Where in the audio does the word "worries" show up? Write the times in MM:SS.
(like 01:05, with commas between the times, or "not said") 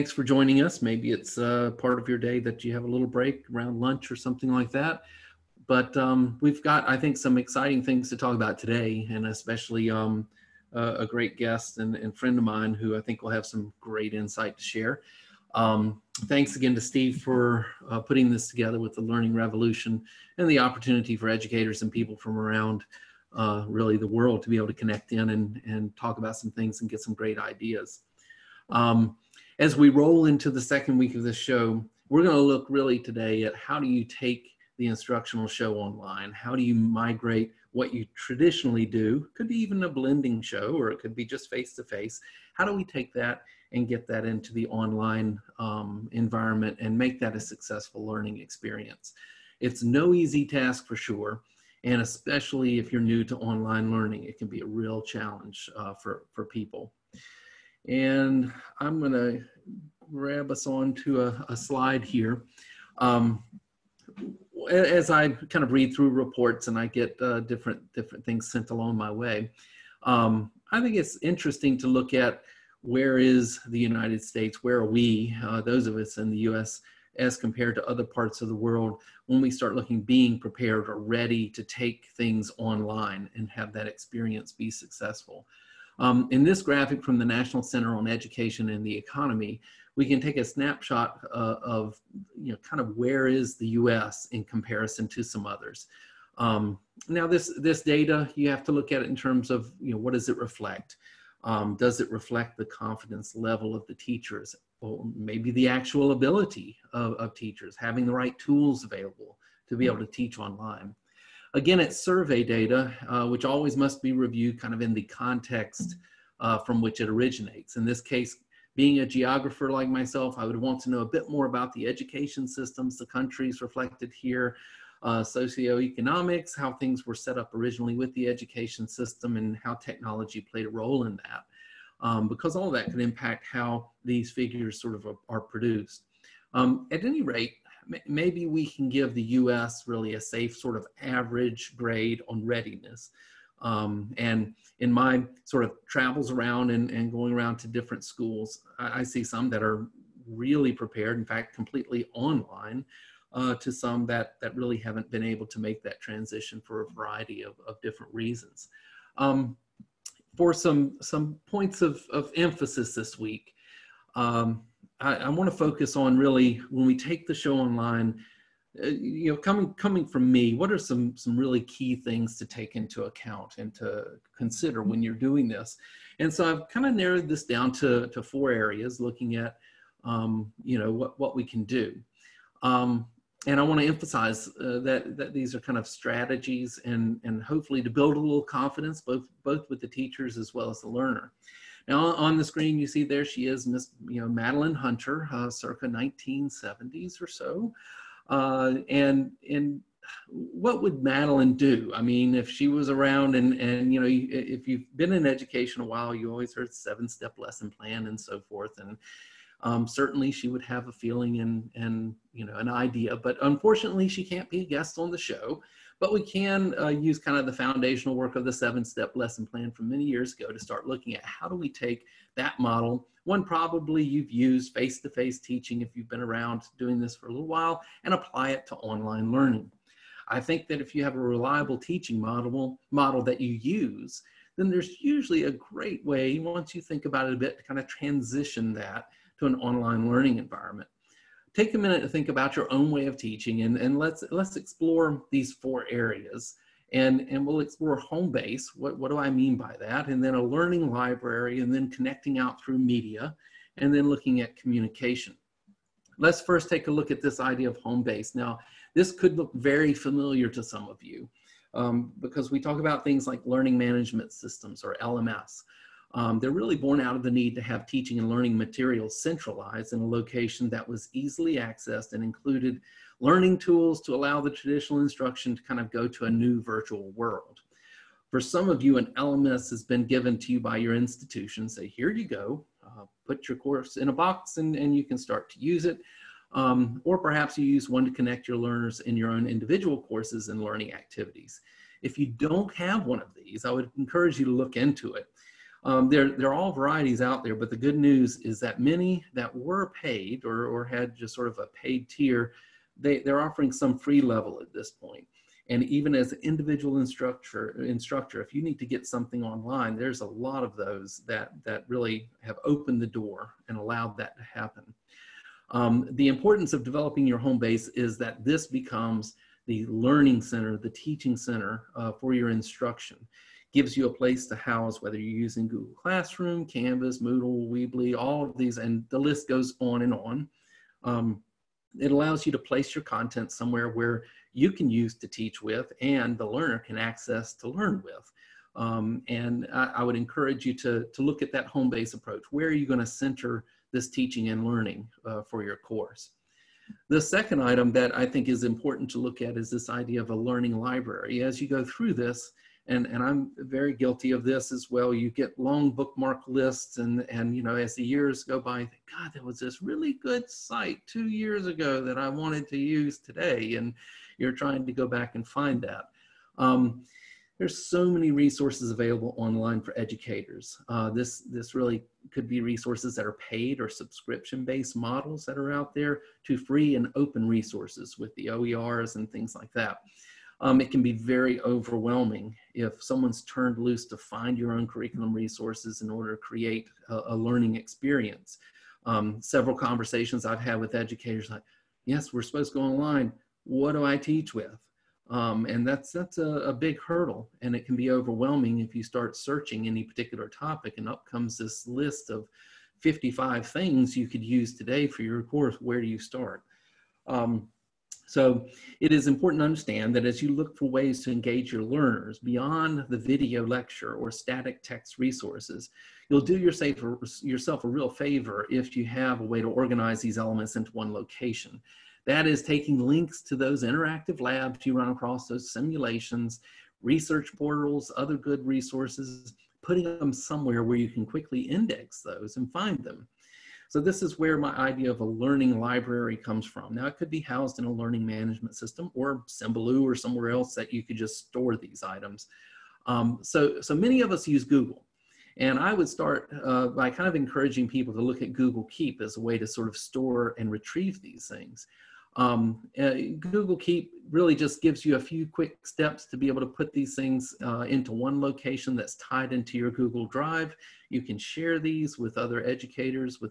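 not said.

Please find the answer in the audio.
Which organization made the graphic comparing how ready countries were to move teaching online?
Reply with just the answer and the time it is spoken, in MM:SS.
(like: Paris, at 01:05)
National Center on Education and the Economy, at 01:27.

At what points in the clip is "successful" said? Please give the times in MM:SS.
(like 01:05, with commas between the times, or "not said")
00:47, 01:24.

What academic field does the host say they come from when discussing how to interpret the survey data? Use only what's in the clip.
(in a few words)
Geographer.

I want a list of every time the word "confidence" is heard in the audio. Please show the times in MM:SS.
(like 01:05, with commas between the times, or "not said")
01:42, 03:08.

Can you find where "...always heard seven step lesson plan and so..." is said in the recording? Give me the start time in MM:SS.
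03:26.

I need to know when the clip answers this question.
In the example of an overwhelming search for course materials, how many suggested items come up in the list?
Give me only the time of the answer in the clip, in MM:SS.
06:42.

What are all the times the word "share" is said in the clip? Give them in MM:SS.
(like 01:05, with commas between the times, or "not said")
00:14, 07:41.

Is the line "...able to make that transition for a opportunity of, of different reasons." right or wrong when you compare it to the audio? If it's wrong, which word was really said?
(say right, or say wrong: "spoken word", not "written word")
wrong: "variety", not "opportunity".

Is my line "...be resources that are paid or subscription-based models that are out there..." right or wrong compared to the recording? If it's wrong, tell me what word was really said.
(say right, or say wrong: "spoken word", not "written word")
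right.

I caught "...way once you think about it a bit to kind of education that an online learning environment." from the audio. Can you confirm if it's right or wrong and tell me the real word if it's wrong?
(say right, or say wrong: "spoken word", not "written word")
wrong: "transition", not "education".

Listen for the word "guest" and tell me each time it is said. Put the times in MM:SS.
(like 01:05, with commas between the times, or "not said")
00:11, 03:34.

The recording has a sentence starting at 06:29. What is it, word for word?
Um, several conversations I've had with educators like, yes, we're supposed to go online.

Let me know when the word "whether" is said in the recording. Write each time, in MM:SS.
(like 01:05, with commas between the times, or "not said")
05:25.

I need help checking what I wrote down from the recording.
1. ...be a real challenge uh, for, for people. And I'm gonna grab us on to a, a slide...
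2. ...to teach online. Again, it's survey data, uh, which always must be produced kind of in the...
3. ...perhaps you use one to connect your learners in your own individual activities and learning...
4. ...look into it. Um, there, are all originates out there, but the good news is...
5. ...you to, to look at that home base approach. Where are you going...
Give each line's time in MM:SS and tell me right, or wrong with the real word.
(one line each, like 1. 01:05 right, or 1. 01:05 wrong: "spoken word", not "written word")
1. 00:54 right
2. 01:49 wrong: "reviewed", not "produced"
3. 04:47 wrong: "courses", not "activities"
4. 04:54 wrong: "varieties", not "originates"
5. 05:40 right.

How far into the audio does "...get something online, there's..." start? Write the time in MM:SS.
05:08.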